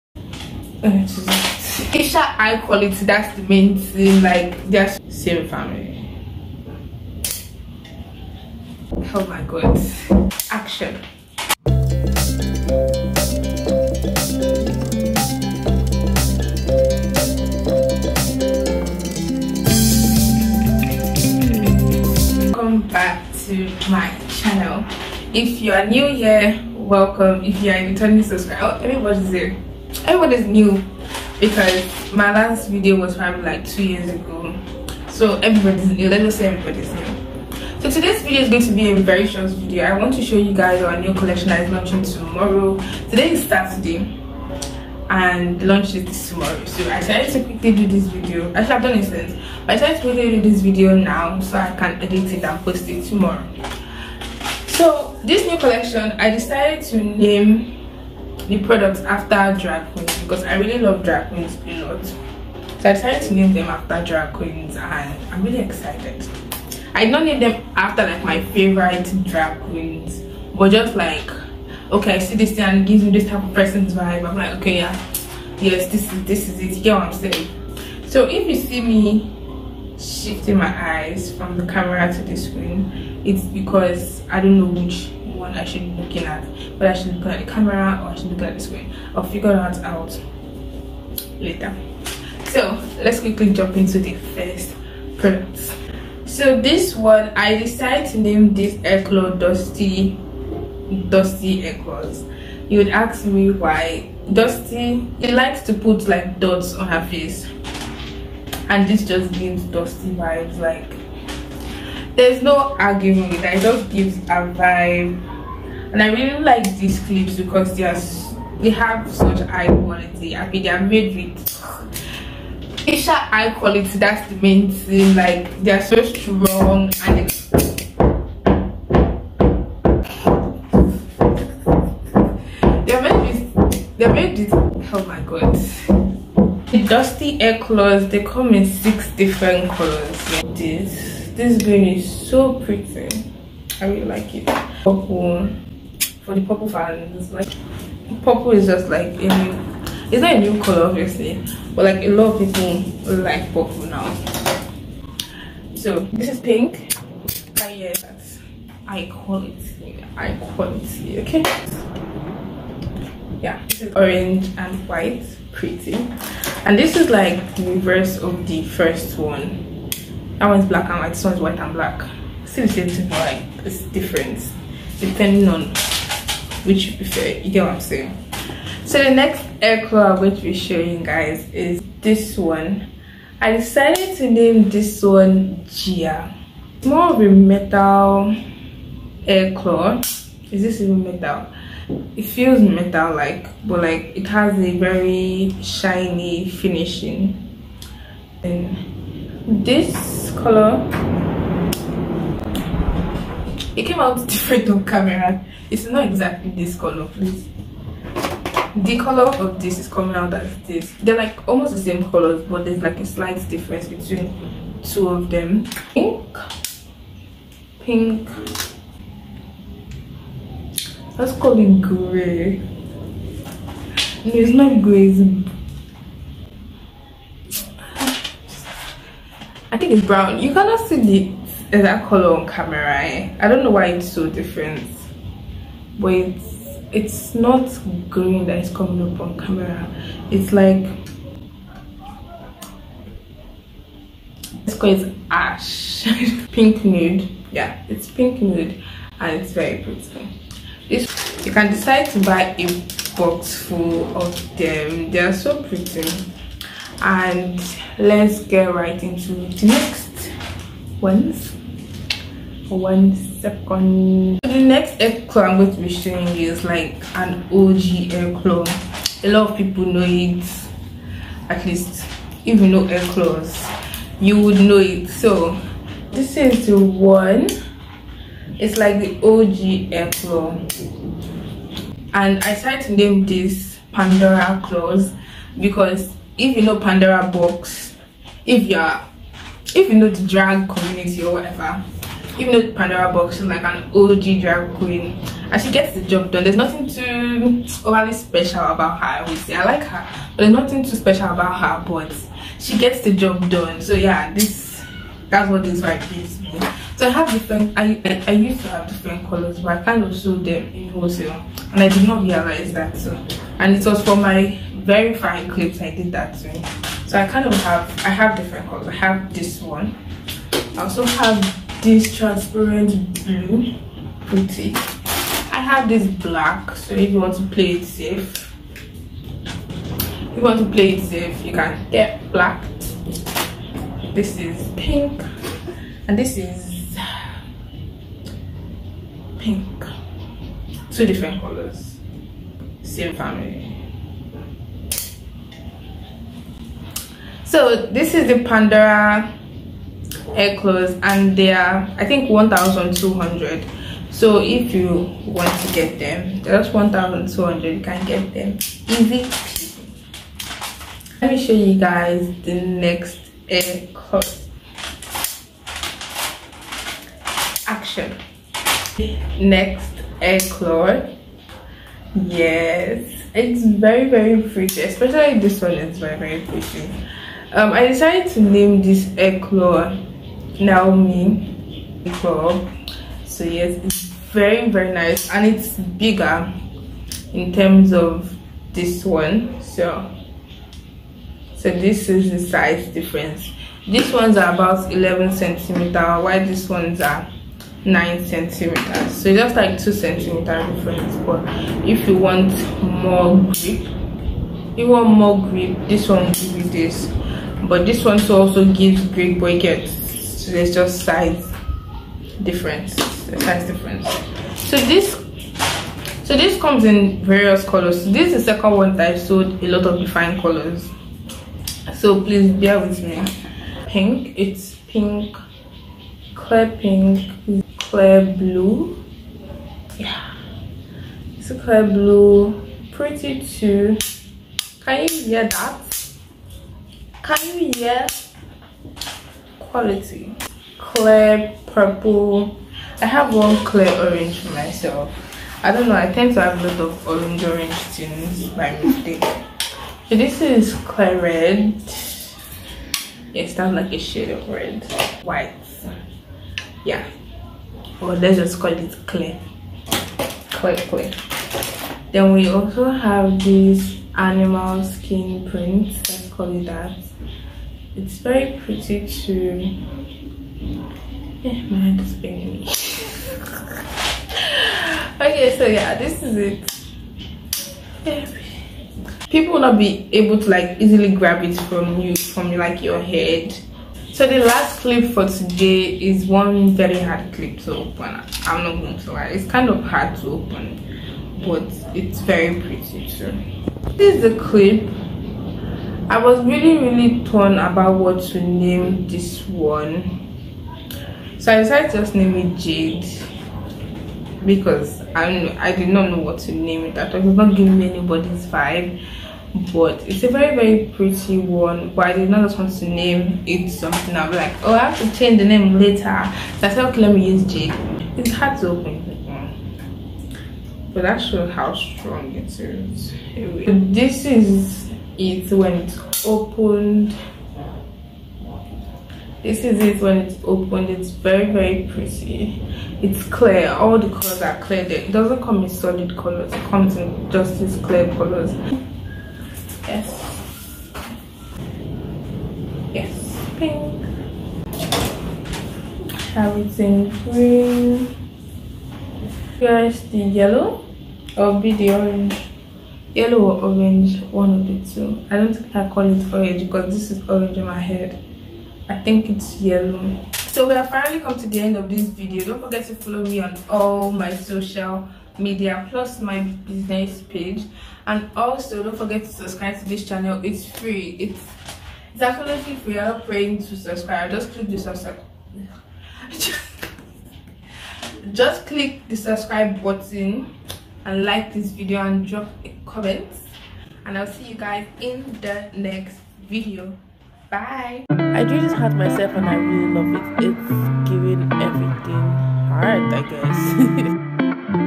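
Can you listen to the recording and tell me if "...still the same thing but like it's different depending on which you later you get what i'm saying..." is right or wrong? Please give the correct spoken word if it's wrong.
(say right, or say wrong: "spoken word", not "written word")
wrong: "prefer", not "later".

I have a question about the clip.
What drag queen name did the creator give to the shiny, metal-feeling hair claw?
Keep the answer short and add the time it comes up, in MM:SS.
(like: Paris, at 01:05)
Gia, at 03:05.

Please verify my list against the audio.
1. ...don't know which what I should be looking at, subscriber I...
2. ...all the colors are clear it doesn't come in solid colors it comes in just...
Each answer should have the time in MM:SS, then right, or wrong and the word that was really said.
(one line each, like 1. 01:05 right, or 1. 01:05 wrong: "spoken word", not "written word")
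1. 01:24 wrong: "whether", not "subscriber"
2. 08:53 right.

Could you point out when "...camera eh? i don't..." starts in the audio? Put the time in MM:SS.
03:52.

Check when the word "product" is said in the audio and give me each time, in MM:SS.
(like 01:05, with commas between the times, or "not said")
00:58, 01:35.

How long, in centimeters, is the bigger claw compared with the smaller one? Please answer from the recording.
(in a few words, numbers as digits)
11 centimeters.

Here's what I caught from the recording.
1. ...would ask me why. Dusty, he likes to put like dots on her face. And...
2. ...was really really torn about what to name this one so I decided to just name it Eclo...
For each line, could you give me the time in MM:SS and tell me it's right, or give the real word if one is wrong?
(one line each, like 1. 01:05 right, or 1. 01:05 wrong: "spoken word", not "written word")
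1. 01:42 right
2. 08:16 wrong: "Jade", not "Eclo".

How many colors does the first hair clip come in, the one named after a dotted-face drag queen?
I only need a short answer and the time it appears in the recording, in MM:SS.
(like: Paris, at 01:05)
6, at 02:18.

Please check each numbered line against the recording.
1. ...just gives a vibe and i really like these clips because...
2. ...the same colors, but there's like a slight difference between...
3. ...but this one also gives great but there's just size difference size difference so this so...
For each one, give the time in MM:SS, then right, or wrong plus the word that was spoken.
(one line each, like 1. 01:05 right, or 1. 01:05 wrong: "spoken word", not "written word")
1. 01:53 right
2. 03:31 right
3. 06:47 right.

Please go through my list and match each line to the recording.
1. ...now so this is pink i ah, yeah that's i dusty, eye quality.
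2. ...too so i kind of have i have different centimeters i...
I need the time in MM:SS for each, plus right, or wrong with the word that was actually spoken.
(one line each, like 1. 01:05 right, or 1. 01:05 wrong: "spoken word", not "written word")
1. 02:33 wrong: "quality", not "dusty"
2. 05:16 wrong: "colors", not "centimeters".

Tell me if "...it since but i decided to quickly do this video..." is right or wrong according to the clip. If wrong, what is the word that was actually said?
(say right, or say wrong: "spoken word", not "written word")
right.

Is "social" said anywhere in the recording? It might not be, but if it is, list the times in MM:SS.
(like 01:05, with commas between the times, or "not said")
09:24.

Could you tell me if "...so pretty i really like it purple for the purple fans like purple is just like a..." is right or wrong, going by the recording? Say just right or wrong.
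right.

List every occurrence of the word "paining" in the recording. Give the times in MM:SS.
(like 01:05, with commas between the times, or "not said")
07:52.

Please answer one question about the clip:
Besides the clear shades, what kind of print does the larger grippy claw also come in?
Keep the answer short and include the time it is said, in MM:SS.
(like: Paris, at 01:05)
Animal skin print, at 07:44.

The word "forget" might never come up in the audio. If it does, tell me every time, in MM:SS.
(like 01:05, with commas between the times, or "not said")
09:22, 09:28.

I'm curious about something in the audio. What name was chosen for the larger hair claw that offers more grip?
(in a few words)
Naomi.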